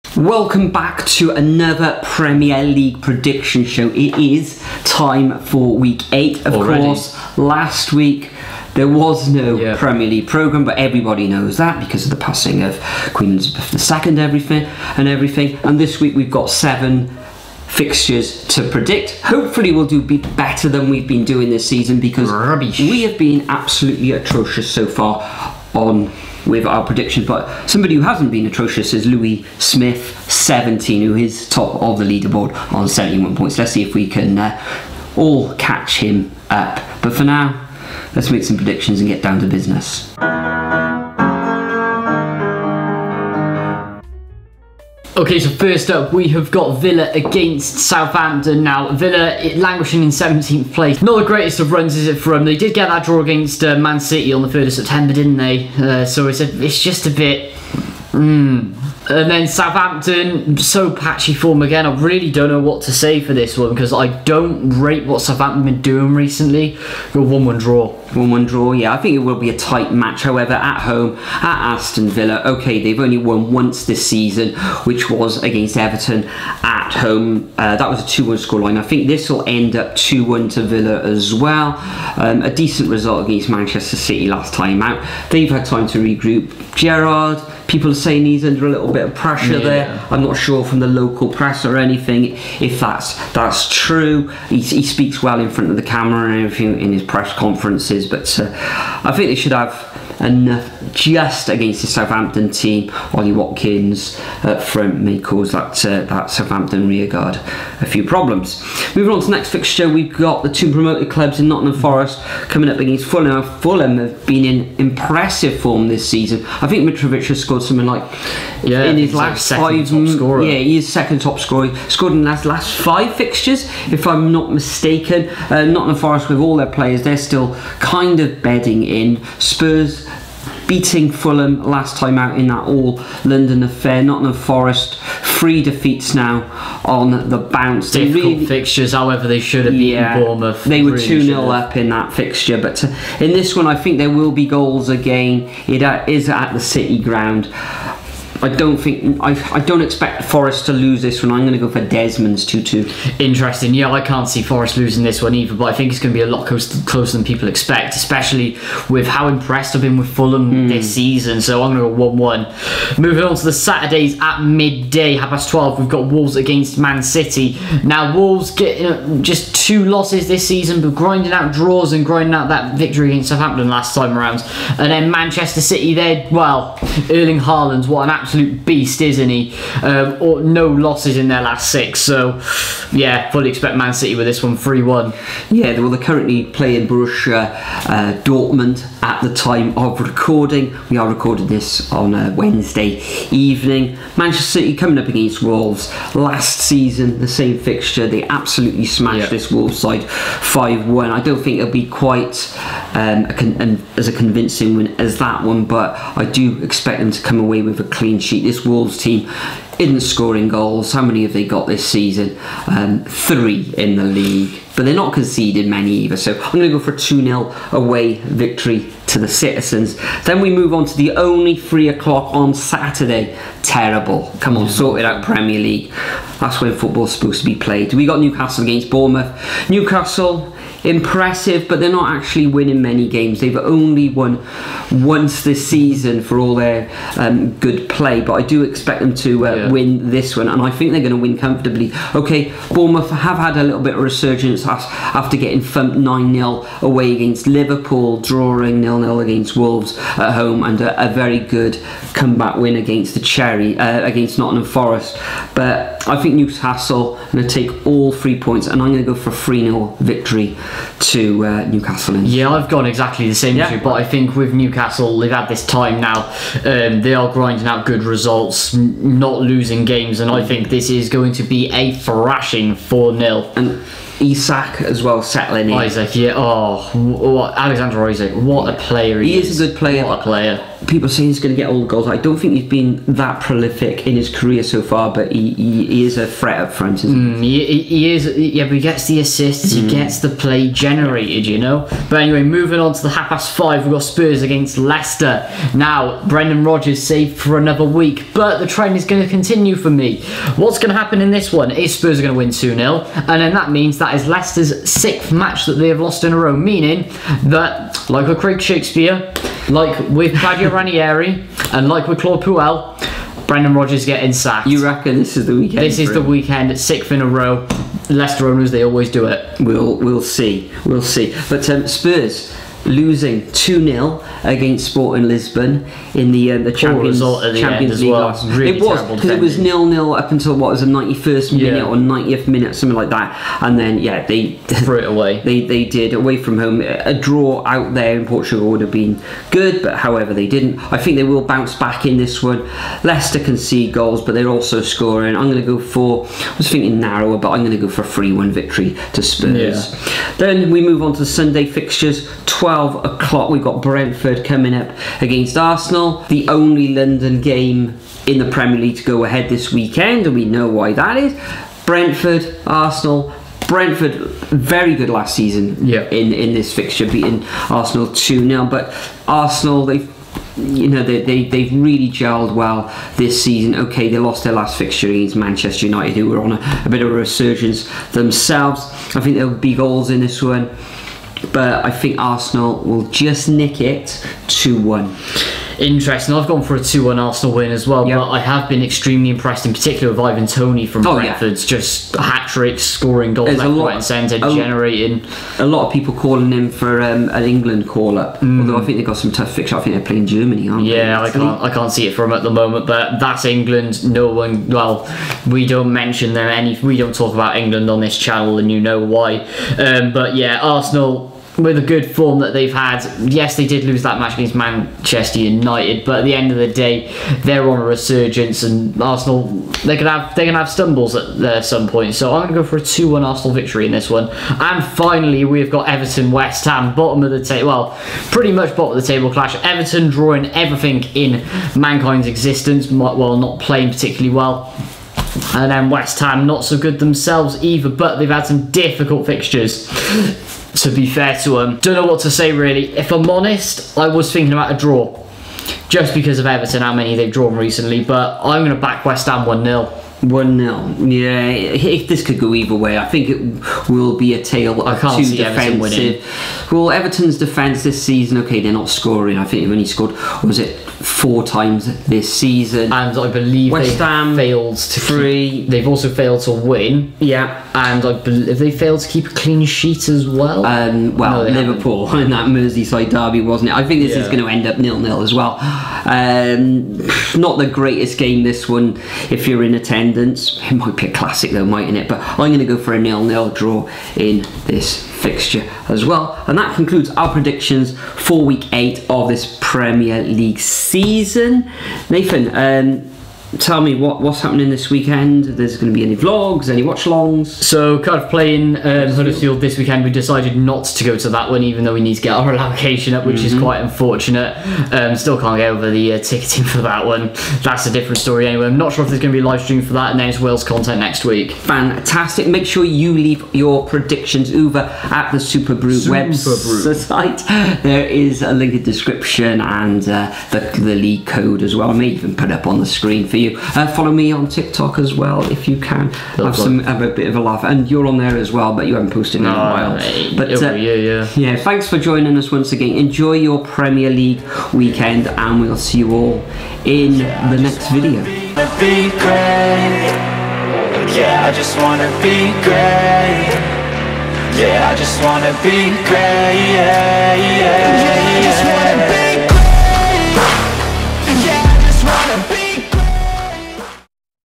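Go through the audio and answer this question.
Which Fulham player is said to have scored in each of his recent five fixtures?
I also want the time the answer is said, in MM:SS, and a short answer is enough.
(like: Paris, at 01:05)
Mitrovic, at 01:56.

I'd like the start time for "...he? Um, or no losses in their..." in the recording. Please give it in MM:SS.
02:59.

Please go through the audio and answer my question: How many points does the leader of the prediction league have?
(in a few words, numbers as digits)
71.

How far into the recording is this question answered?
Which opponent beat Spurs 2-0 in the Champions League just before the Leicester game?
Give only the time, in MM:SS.
05:24.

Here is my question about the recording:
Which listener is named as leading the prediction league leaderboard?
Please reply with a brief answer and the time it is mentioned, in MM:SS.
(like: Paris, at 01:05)
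Louis Smith, at 00:29.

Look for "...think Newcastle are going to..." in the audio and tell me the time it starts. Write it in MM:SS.
04:16.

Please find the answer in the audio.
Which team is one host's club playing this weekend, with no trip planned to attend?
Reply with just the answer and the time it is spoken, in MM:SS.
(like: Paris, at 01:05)
Huddersfield, at 08:19.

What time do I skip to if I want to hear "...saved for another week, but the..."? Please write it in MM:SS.
04:57.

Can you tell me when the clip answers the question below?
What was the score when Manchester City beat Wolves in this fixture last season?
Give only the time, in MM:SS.
03:20.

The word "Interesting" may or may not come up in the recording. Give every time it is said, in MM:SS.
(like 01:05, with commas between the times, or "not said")
02:33, 06:25.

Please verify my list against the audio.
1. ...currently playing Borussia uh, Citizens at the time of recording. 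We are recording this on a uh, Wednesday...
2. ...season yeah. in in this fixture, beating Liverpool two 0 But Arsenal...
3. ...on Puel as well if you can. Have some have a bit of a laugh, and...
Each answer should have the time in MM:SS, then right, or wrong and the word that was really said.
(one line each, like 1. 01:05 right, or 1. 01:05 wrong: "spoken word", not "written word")
1. 03:06 wrong: "Dortmund", not "Citizens"
2. 06:05 wrong: "Arsenal", not "Liverpool"
3. 08:44 wrong: "TikTok", not "Puel".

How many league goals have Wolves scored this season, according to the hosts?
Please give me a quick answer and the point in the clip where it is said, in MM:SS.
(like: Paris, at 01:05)
3, at 03:33.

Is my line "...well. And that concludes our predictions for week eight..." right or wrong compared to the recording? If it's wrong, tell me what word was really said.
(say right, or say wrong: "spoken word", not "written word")
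right.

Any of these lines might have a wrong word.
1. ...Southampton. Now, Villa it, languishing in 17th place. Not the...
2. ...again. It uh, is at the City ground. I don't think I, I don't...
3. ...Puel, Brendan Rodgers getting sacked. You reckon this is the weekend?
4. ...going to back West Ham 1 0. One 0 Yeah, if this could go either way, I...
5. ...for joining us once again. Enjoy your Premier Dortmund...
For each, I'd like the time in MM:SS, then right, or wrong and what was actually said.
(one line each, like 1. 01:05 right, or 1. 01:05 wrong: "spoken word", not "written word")
1. 00:47 right
2. 02:24 right
3. 05:12 right
4. 07:28 right
5. 08:51 wrong: "League", not "Dortmund".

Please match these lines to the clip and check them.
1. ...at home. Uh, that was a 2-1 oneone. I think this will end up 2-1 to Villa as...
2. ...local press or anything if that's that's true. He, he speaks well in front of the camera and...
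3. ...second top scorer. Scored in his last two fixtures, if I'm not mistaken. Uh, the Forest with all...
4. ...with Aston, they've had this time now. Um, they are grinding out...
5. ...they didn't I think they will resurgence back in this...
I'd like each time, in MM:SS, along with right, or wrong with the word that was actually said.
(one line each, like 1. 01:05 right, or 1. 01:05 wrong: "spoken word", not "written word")
1. 01:16 wrong: "scoreline", not "oneone"
2. 01:30 right
3. 02:00 wrong: "five", not "two"
4. 04:24 wrong: "Newcastle", not "Aston"
5. 05:40 wrong: "bounce", not "resurgence".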